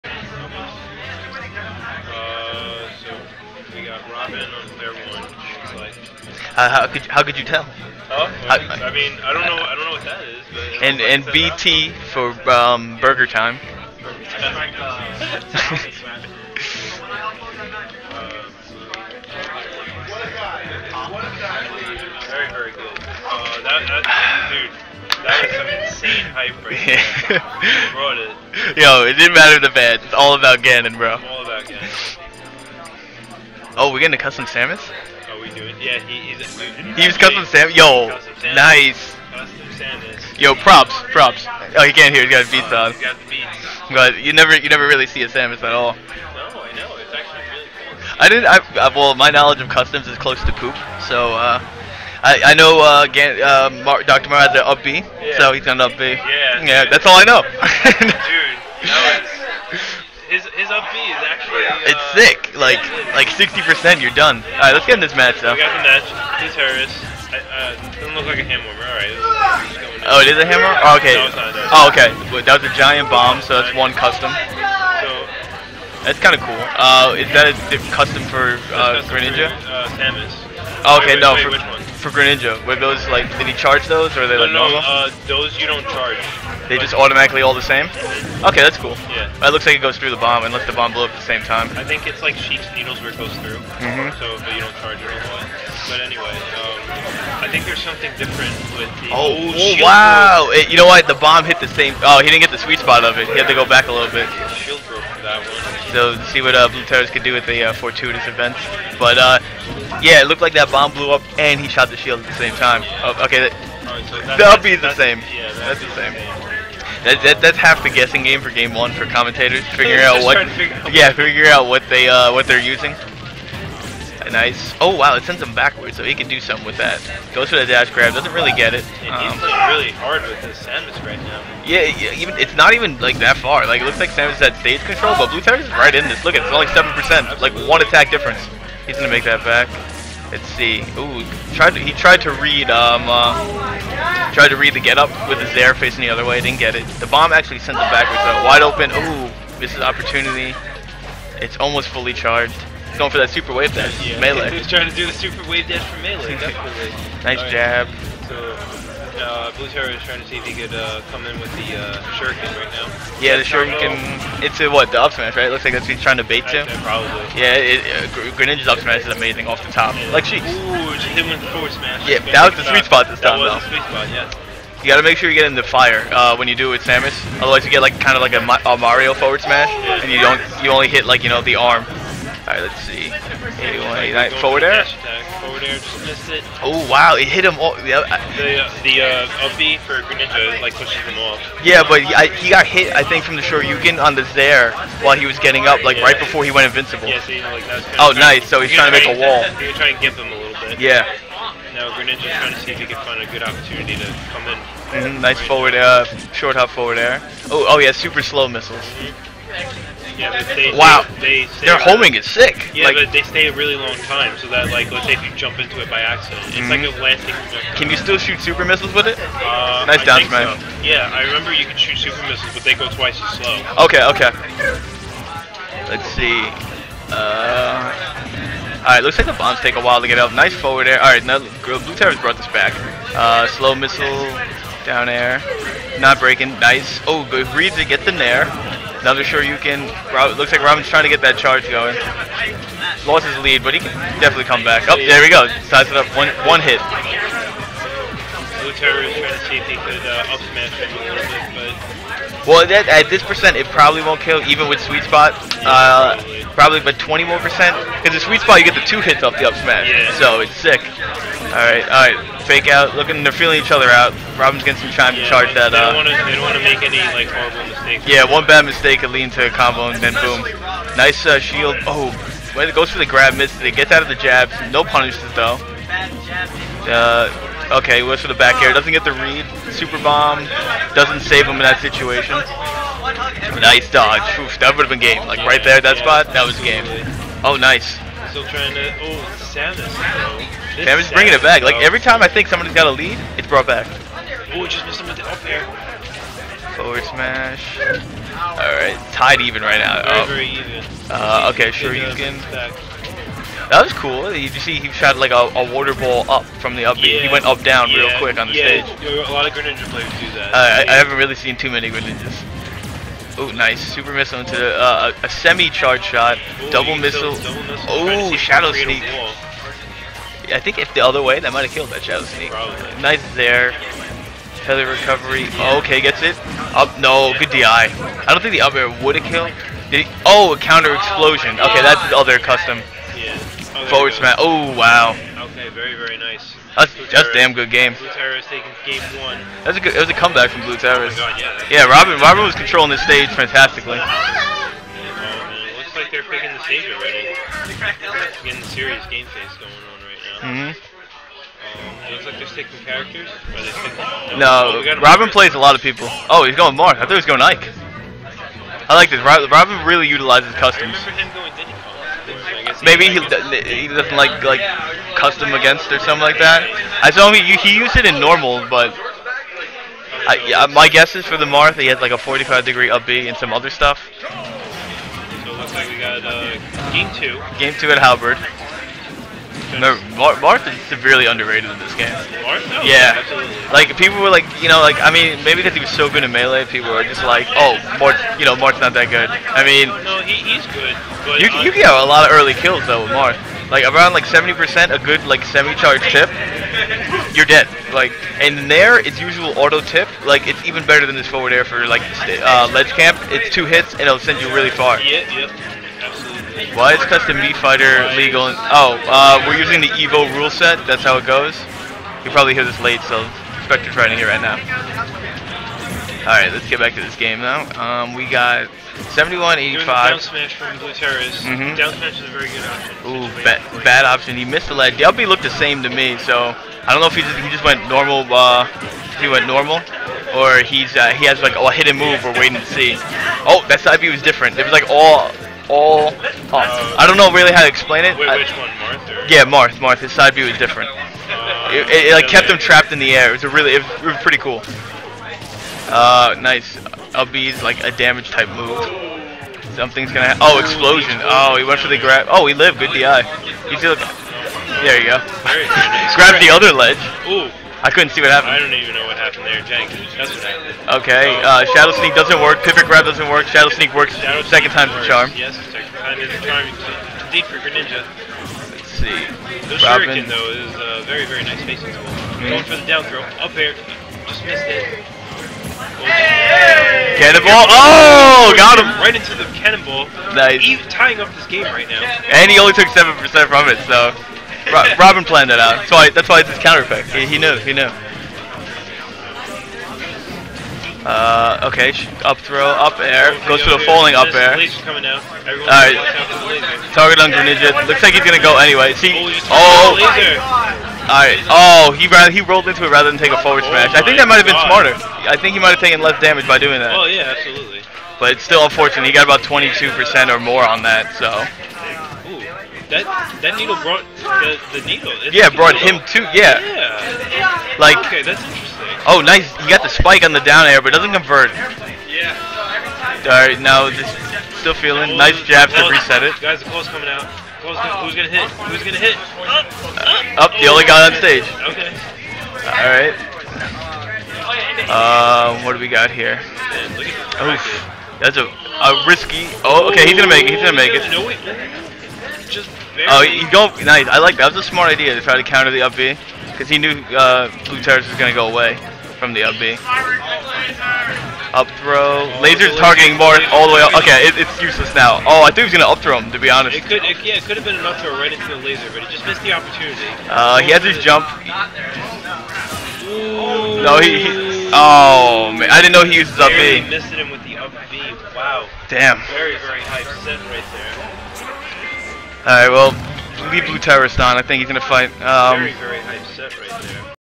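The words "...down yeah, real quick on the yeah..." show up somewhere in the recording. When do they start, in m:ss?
5:07.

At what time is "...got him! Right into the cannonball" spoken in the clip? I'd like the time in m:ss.
7:58.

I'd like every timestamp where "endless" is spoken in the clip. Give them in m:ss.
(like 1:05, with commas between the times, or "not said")
not said.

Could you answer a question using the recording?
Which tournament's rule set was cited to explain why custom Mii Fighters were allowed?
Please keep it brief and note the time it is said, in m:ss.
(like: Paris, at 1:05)
Evo, at 6:49.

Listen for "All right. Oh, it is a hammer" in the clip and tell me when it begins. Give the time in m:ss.
1:08.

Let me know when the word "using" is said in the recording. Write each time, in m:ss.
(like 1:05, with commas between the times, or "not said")
2:02, 6:49.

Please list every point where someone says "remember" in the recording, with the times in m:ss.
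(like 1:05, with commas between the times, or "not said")
3:41, 6:01.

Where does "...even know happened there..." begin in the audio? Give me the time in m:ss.
7:38.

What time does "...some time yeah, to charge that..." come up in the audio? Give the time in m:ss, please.
4:24.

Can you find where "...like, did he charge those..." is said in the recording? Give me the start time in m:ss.
1:23.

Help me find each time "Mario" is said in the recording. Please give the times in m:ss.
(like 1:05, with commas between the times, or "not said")
0:54, 2:58.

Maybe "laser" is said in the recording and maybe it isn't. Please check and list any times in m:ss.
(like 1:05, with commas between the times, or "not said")
9:12, 9:18.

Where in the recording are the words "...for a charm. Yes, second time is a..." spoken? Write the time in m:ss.
7:44.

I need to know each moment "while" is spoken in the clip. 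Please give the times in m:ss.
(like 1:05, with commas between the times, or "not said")
3:15, 3:49.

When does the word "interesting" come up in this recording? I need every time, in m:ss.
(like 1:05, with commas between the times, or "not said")
8:38.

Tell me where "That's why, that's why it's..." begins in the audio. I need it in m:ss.
8:05.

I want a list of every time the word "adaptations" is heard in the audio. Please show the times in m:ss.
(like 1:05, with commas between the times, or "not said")
not said.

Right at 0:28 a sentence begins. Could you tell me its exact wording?
Yo, it didn't matter the bad.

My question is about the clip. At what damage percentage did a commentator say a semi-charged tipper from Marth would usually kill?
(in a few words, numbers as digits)
70%.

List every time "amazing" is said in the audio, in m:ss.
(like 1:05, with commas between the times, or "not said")
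2:49.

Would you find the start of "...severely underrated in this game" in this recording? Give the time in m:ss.
6:20.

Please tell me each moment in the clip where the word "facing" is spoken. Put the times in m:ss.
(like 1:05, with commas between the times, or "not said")
2:25, 7:51.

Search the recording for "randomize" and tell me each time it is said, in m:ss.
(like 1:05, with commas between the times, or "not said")
not said.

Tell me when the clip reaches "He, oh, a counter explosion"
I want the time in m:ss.
5:29.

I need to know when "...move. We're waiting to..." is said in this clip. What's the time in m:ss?
7:11.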